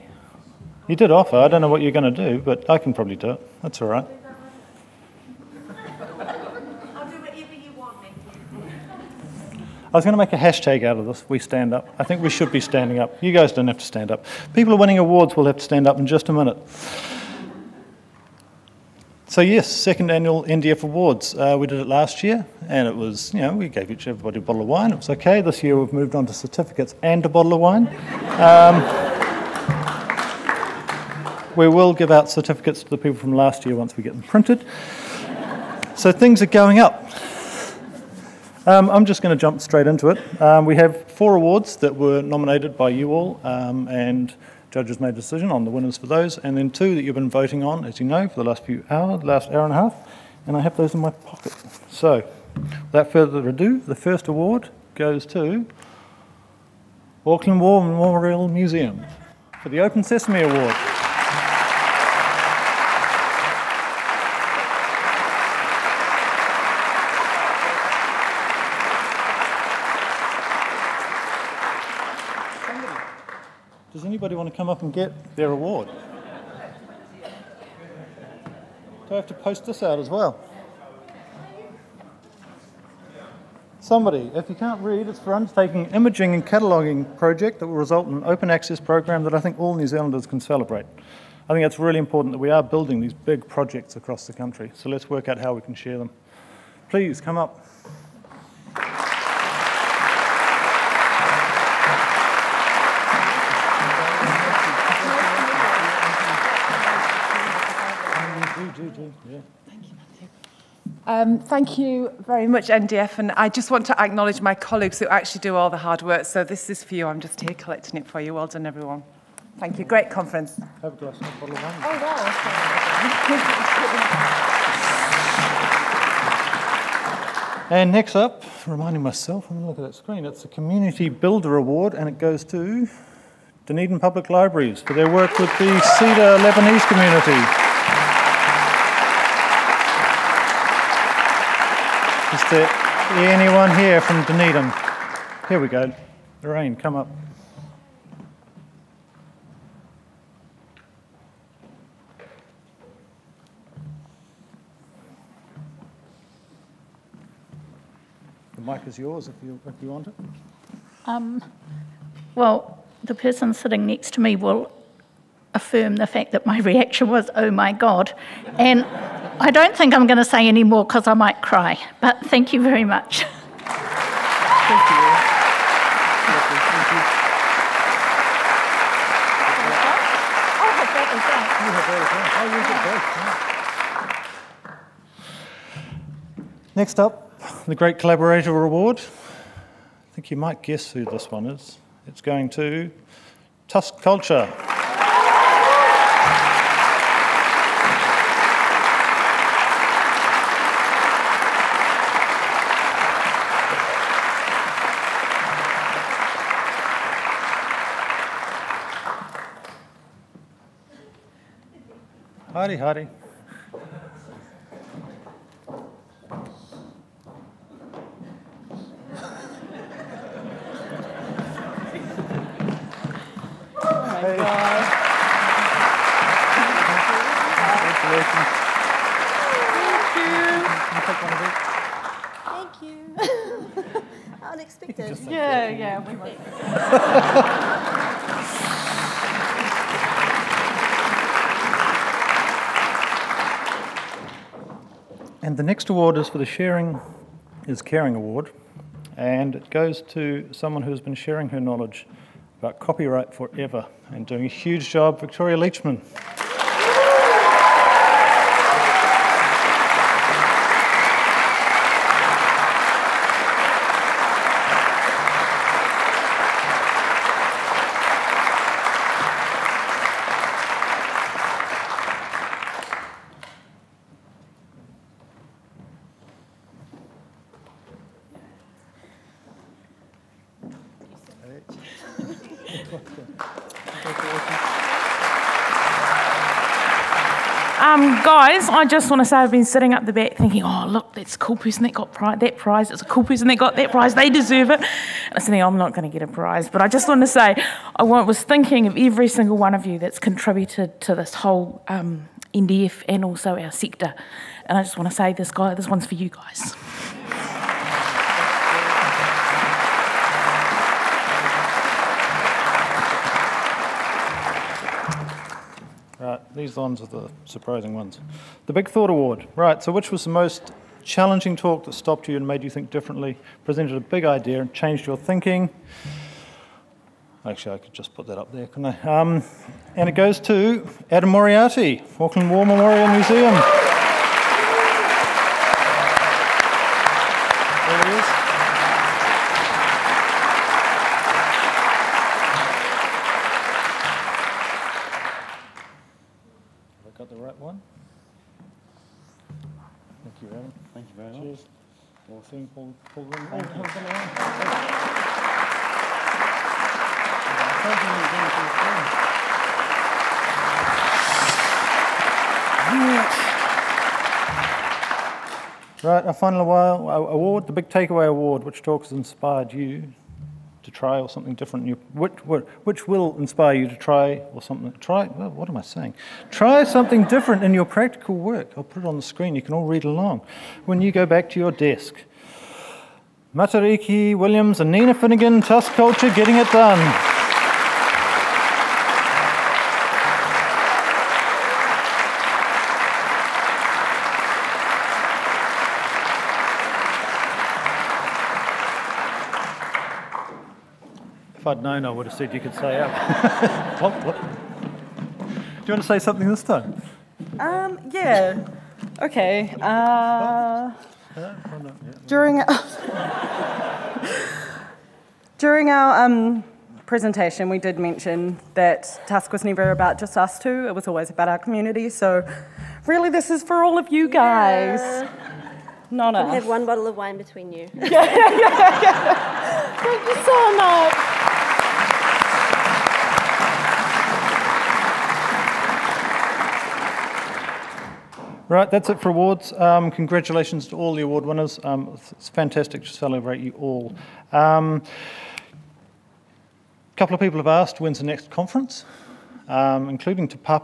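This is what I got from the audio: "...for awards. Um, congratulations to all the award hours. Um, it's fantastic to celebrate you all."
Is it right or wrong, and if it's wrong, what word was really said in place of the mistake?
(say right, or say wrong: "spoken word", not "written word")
wrong: "winners", not "hours".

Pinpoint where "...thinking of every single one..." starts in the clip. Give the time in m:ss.
4:58.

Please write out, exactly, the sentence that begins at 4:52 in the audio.
It's a cool person that got that prize.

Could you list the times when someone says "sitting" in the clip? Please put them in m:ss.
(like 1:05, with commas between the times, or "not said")
2:43, 4:49.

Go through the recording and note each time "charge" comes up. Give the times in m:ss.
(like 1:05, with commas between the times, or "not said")
not said.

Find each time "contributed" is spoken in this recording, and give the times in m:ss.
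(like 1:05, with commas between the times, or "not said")
5:00.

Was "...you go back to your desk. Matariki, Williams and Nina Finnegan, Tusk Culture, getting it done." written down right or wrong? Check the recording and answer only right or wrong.
right.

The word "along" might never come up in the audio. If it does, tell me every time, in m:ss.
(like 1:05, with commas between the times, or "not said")
6:20.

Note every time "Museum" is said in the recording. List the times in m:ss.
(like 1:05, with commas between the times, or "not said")
0:58, 5:33.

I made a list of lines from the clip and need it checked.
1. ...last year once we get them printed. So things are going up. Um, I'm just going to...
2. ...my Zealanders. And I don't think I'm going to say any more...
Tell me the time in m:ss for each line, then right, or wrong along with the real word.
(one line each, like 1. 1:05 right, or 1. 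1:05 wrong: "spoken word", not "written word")
1. 0:33 right
2. 2:47 wrong: "God", not "Zealanders".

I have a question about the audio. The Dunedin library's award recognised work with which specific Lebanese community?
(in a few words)
Cedar.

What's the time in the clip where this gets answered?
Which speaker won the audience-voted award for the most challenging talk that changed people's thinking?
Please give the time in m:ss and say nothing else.
5:31.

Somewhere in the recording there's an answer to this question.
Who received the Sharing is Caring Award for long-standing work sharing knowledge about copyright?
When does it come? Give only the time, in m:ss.
4:15.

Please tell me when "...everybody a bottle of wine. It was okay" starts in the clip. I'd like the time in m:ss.
0:24.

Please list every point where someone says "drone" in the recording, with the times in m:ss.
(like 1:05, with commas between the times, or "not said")
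not said.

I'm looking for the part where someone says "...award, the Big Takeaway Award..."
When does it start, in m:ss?
6:07.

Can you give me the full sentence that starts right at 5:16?
Right, uh, these ones are the surprising ones.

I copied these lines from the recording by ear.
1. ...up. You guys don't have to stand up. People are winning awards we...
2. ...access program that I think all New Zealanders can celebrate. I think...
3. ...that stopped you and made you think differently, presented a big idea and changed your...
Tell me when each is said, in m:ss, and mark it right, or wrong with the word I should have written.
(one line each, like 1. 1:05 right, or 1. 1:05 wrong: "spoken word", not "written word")
1. 0:13 right
2. 1:28 right
3. 5:21 right.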